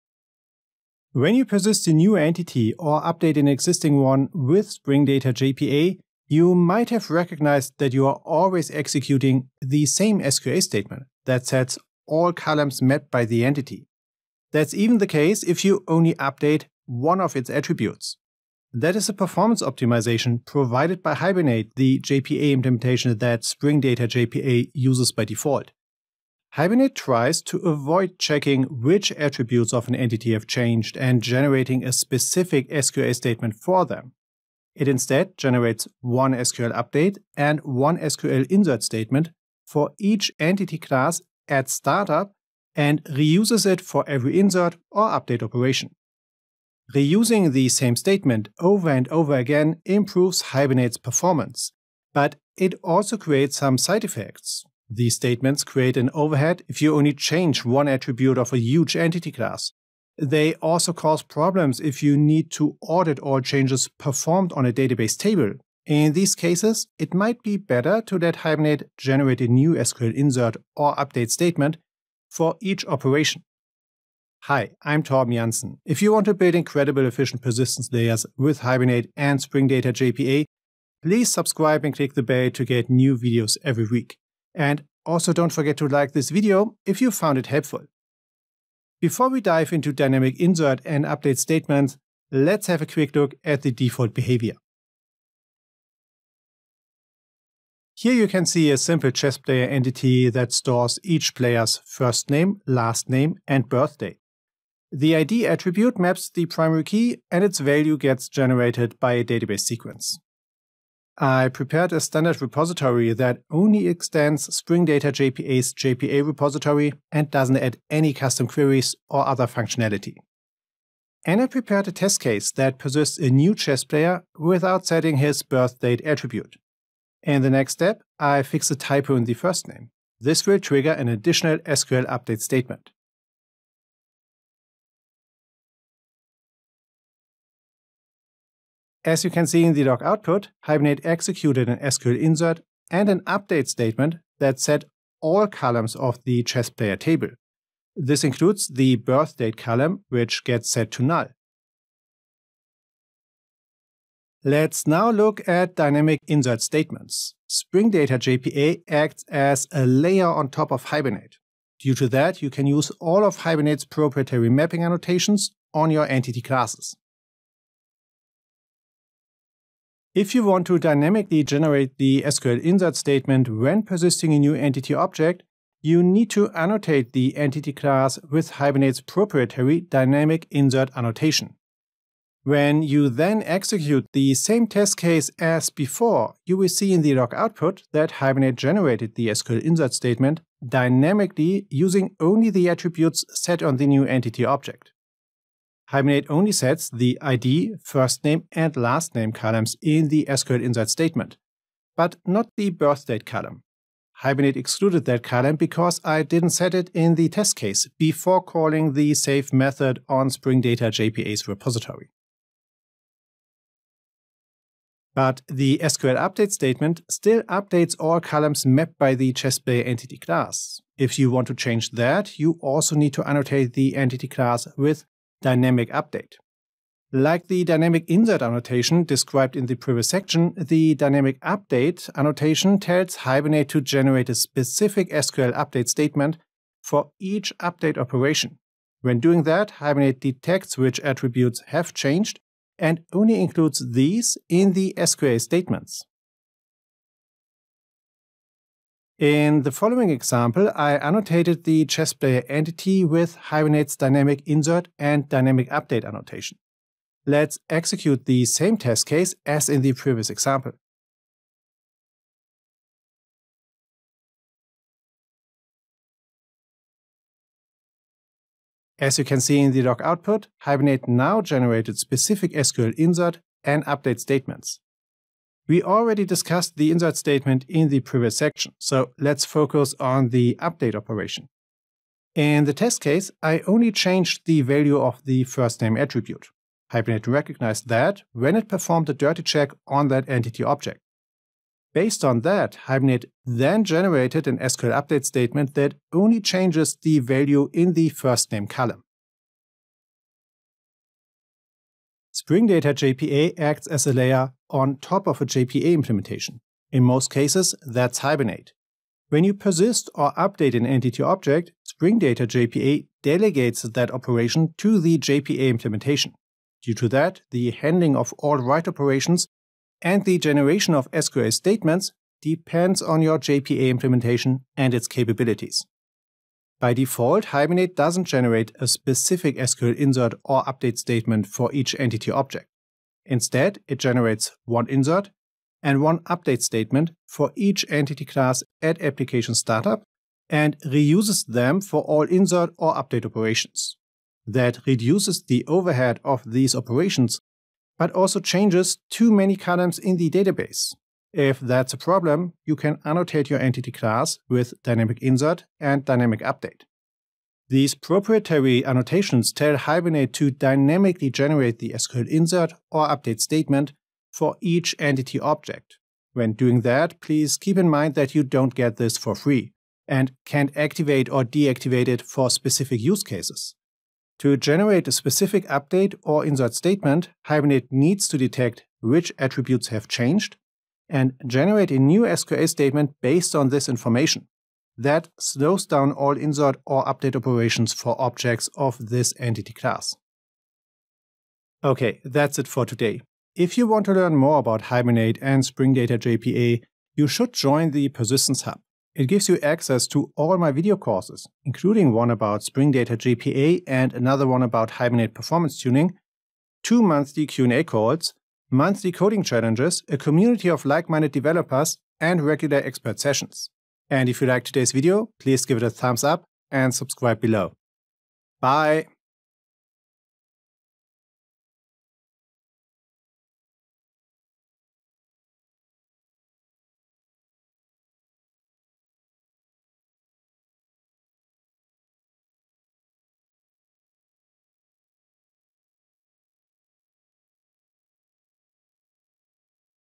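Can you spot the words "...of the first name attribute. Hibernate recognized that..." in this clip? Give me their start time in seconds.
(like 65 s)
284 s.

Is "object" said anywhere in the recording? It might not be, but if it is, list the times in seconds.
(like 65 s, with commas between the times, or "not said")
174 s, 194 s, 290 s, 311 s, 332 s, 365 s, 388 s.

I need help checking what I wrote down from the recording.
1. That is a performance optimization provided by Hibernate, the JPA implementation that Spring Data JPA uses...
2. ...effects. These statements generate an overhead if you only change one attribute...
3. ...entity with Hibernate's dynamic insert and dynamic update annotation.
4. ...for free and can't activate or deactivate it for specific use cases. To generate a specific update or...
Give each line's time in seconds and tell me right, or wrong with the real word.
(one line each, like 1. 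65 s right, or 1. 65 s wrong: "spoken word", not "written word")
1. 18 s right
2. 54 s wrong: "create", not "generate"
3. 252 s right
4. 369 s right.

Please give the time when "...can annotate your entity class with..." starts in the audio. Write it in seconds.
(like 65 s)
352 s.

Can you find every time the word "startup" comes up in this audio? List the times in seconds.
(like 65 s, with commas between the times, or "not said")
41 s, 339 s.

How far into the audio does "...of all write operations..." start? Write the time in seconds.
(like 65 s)
318 s.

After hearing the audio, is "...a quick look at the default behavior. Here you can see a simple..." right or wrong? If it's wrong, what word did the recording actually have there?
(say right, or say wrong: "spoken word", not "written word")
right.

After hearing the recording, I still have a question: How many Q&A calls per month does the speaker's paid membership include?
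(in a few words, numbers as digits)
2.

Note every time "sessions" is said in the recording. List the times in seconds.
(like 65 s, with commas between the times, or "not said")
413 s.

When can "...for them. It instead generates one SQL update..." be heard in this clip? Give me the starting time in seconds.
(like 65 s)
33 s.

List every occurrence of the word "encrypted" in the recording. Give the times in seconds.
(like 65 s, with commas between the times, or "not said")
not said.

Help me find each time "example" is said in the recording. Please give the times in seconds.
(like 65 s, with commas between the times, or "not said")
250 s, 260 s.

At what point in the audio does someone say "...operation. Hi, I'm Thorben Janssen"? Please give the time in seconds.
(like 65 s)
72 s.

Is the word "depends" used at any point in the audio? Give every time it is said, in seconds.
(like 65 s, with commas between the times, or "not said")
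322 s.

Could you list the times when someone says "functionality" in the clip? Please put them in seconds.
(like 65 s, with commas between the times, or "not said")
119 s.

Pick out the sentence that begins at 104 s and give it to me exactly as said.
The ID attribute maps the primary key and its value gets generated by a database sequence.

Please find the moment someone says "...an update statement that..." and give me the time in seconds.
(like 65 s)
143 s.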